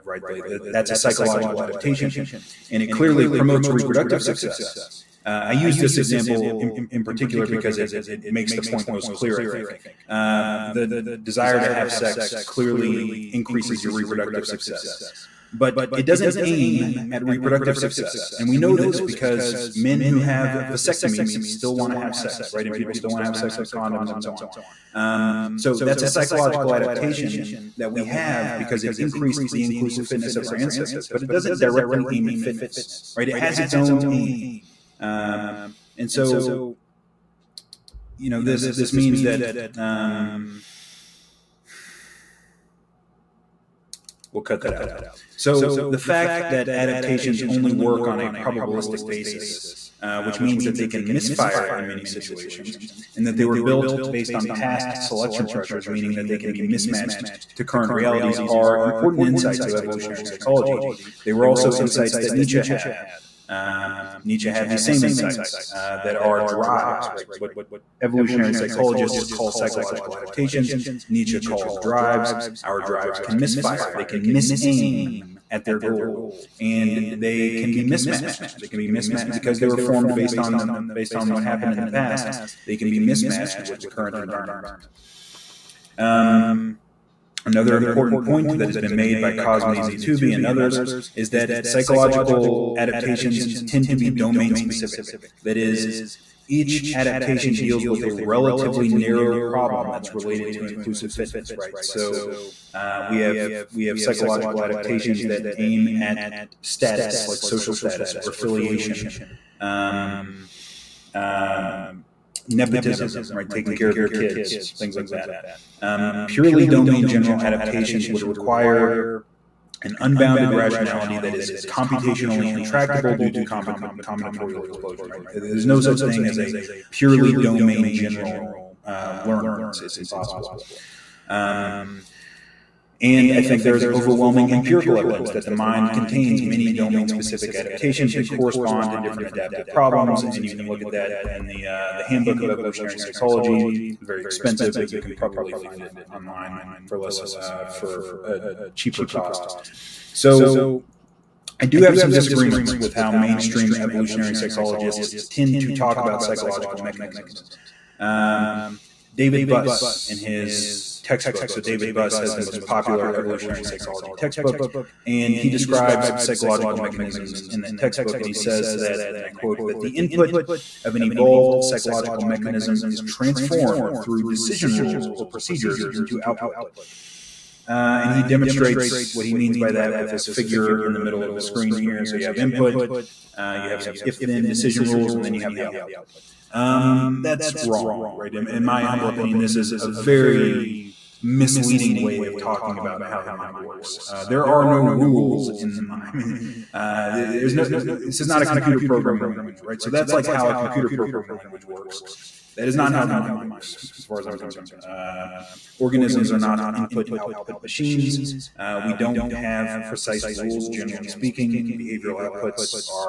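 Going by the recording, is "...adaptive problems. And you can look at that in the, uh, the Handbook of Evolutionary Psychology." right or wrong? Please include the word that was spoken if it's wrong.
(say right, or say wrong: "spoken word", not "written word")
right.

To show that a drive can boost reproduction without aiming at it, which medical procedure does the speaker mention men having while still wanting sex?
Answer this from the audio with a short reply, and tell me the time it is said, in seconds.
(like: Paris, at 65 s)
vasectomies, at 20 s.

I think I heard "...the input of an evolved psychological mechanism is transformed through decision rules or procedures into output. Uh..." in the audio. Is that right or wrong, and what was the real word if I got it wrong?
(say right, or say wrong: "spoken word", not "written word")
right.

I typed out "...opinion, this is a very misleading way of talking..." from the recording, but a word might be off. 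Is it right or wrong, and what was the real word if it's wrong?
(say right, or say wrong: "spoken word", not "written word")
right.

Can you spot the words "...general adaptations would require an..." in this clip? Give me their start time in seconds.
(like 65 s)
117 s.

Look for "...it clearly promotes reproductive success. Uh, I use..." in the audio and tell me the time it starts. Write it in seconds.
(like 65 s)
2 s.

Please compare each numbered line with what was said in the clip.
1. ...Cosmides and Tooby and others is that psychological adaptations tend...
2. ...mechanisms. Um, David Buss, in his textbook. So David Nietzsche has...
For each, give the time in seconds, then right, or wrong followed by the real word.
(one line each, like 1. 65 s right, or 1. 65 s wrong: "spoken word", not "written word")
1. 89 s right
2. 156 s wrong: "Buss", not "Nietzsche".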